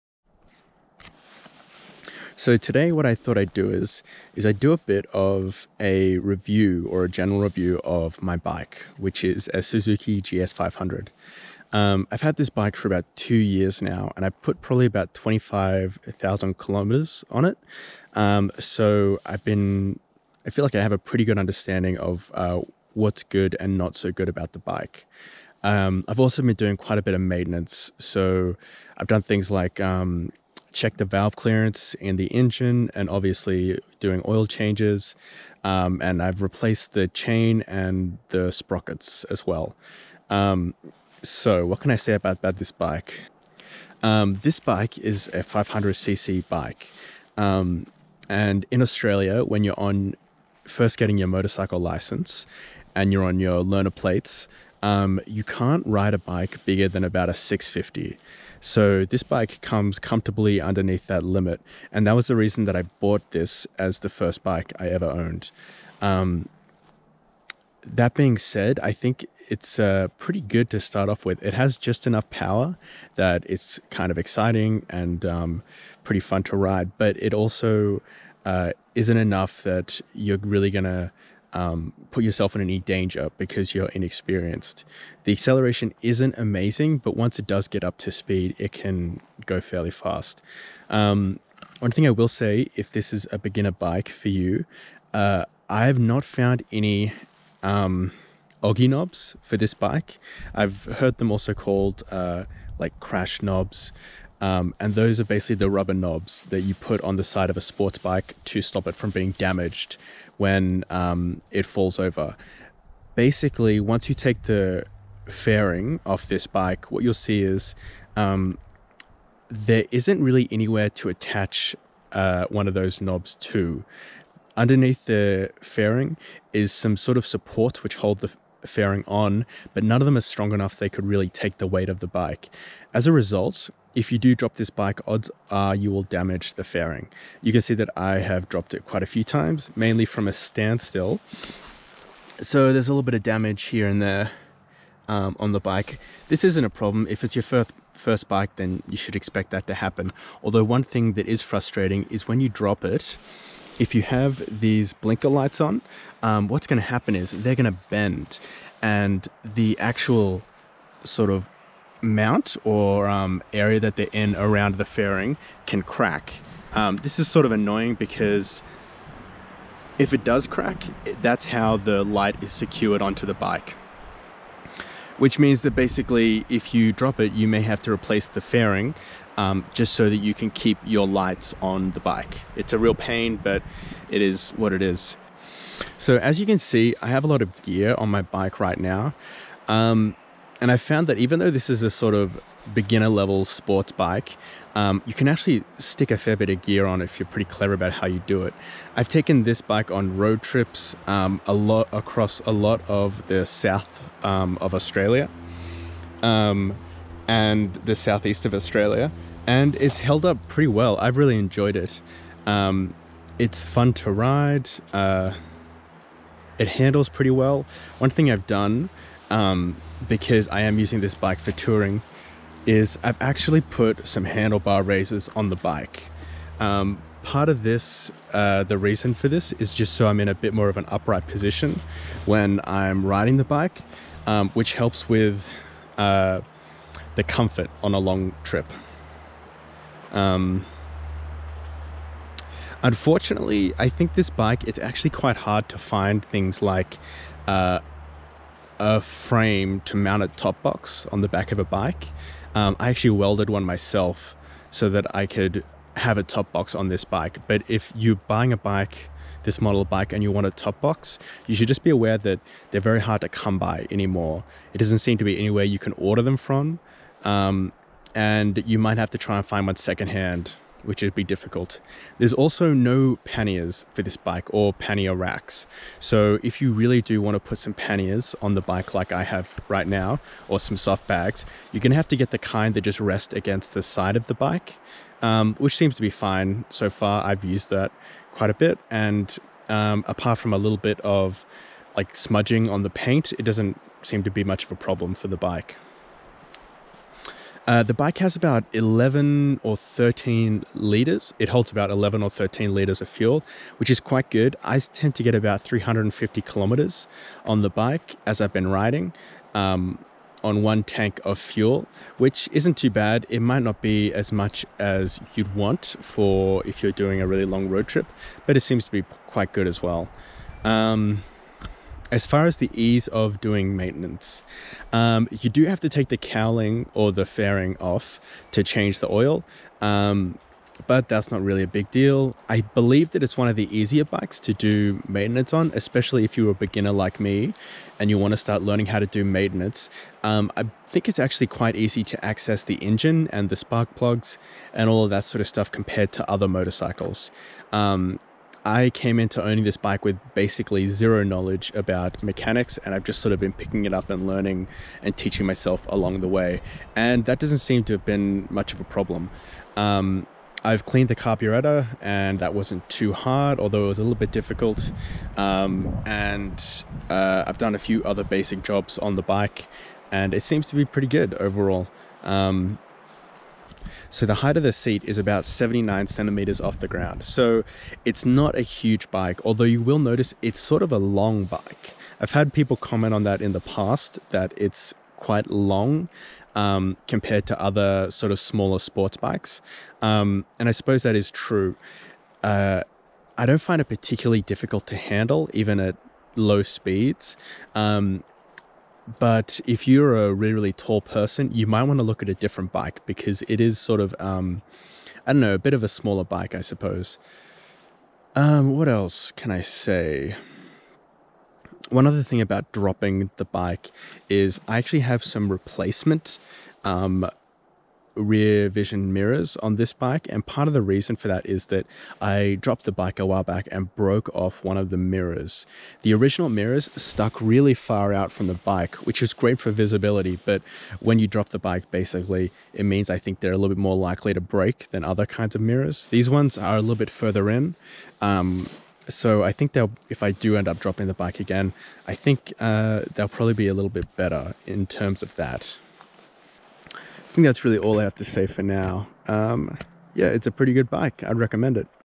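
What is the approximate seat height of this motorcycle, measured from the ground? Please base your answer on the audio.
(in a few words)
79 centimeters.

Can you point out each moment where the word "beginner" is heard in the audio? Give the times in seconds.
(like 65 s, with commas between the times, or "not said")
93 s, 192 s, 336 s.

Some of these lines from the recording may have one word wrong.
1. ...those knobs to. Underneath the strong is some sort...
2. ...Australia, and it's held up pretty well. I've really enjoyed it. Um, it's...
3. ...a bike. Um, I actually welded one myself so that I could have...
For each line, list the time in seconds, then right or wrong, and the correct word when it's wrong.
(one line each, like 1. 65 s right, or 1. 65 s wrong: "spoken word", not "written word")
1. 122 s wrong: "fairing", not "strong"
2. 208 s right
3. 251 s right.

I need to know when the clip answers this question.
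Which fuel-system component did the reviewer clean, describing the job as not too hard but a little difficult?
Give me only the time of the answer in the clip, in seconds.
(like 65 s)
361 s.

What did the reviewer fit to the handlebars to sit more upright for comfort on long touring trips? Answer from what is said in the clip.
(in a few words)
handlebar raises.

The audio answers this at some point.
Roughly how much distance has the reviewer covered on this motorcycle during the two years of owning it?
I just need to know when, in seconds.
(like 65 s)
15 s.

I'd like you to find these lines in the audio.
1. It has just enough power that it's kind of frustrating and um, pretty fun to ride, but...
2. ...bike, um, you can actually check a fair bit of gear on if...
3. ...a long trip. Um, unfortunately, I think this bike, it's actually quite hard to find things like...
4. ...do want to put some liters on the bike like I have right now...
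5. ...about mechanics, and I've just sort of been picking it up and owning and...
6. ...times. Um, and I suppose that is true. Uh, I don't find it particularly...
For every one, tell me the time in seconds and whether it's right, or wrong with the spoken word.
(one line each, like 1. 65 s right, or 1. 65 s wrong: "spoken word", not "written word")
1. 71 s wrong: "exciting", not "frustrating"
2. 193 s wrong: "stick", not "check"
3. 237 s right
4. 277 s wrong: "panniers", not "liters"
5. 351 s wrong: "learning", not "owning"
6. 389 s wrong: "bikes", not "times".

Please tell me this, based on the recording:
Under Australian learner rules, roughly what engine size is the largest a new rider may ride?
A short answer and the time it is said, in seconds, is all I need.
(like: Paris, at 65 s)
650, at 57 s.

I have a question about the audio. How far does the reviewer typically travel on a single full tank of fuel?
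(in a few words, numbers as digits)
350 kilometers.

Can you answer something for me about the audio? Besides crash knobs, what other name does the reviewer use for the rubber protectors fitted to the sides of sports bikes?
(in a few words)
Oggy knobs.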